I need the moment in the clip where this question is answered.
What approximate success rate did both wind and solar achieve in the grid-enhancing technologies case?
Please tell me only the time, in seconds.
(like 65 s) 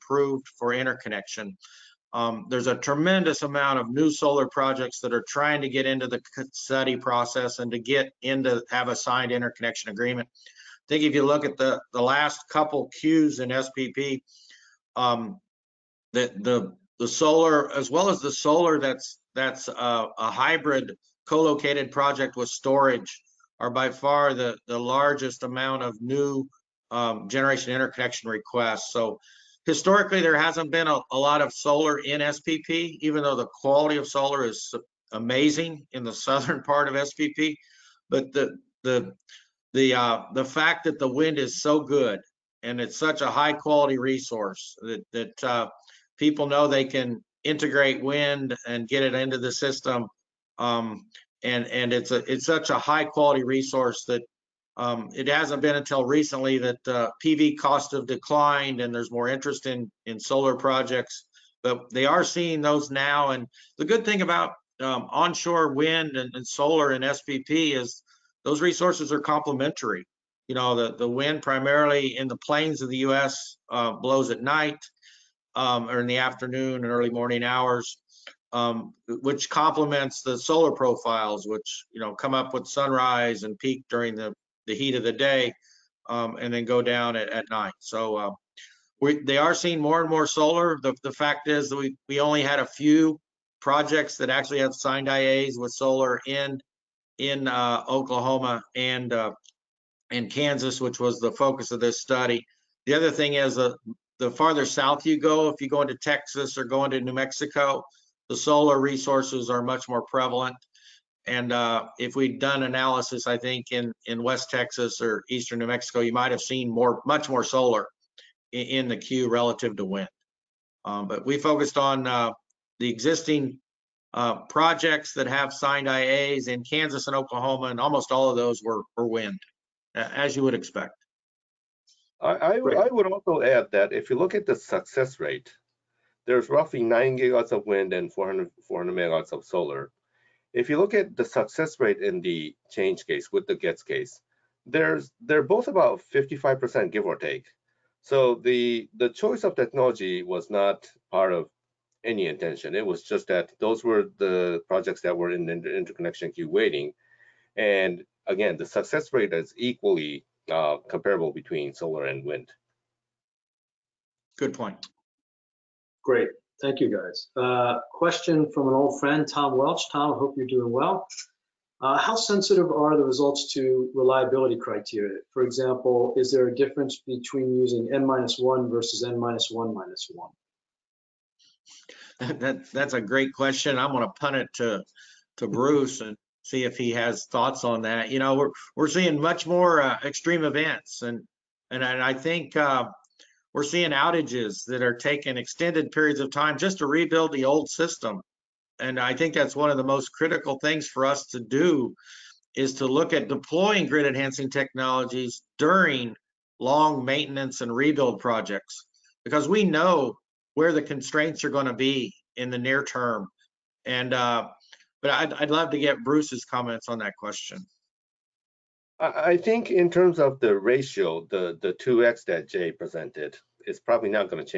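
146 s.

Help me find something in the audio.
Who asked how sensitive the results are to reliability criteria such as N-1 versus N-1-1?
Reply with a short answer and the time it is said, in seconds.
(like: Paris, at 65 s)
Tom Welch, at 169 s.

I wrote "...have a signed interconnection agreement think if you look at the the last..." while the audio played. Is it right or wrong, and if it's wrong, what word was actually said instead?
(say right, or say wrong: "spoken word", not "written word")
right.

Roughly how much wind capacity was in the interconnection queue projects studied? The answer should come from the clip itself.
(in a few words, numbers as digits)
9 gigawatts.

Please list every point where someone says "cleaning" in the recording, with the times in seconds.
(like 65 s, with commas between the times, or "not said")
not said.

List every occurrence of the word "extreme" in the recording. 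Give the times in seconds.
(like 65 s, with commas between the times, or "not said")
190 s.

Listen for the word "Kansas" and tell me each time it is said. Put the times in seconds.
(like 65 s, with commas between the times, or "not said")
100 s, 126 s.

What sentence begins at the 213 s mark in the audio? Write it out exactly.
And uh, but I'd, I'd love to get Bruce's comments on that question.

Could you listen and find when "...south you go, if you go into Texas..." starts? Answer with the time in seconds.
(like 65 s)
104 s.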